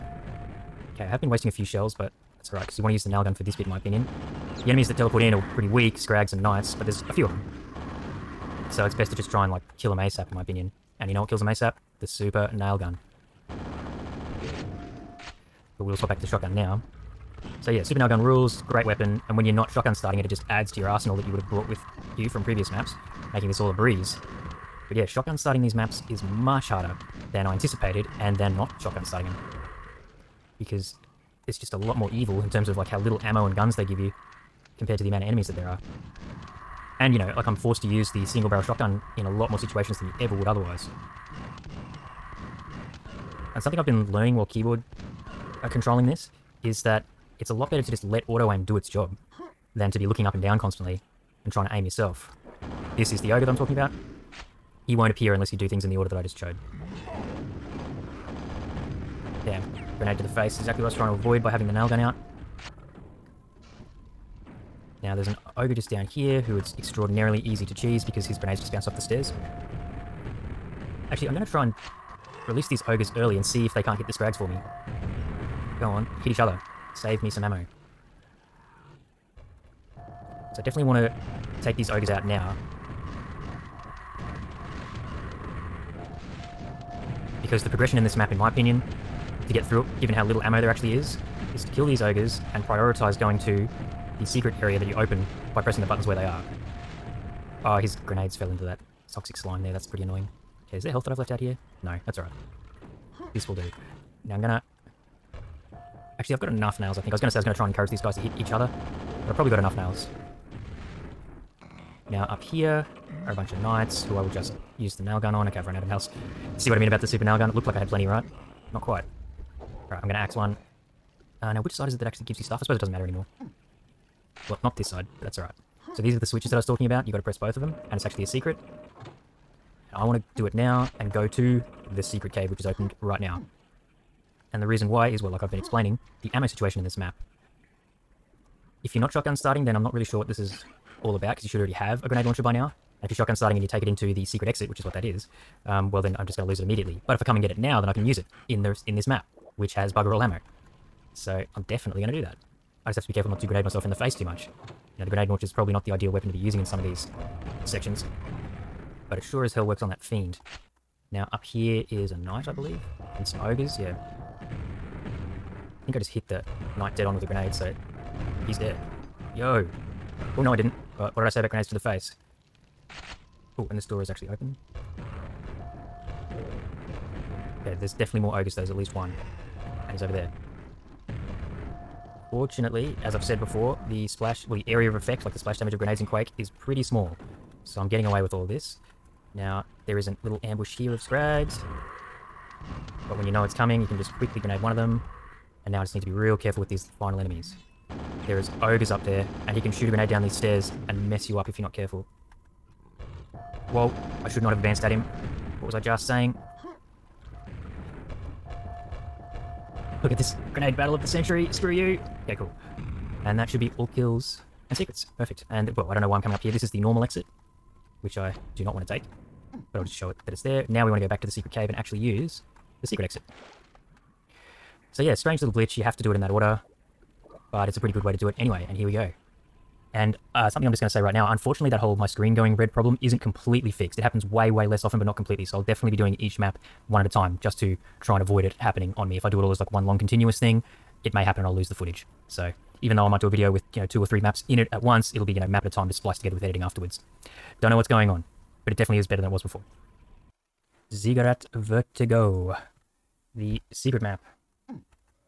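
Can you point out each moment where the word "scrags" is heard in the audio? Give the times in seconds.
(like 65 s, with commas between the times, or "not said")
5 s, 74 s, 191 s.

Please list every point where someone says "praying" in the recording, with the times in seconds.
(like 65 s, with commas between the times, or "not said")
not said.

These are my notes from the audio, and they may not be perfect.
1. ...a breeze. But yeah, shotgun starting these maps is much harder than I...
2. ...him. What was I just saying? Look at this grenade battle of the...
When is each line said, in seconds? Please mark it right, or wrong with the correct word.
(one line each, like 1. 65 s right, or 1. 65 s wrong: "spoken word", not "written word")
1. 23 s right
2. 204 s right.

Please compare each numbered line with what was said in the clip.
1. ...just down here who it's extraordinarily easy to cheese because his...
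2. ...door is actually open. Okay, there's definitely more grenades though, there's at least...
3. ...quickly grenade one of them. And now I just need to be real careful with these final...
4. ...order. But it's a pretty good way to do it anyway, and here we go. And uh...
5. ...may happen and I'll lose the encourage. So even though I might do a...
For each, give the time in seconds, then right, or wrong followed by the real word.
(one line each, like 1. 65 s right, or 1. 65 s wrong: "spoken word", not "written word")
1. 65 s right
2. 173 s wrong: "ogres", not "grenades"
3. 194 s right
4. 226 s right
5. 241 s wrong: "footage", not "encourage".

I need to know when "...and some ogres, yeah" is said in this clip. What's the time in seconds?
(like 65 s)
163 s.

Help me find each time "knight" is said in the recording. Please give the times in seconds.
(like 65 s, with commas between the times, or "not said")
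6 s, 113 s, 162 s, 166 s.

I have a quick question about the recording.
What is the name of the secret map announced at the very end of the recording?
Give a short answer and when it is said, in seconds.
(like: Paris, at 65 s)
Ziggurat Vertigo, at 250 s.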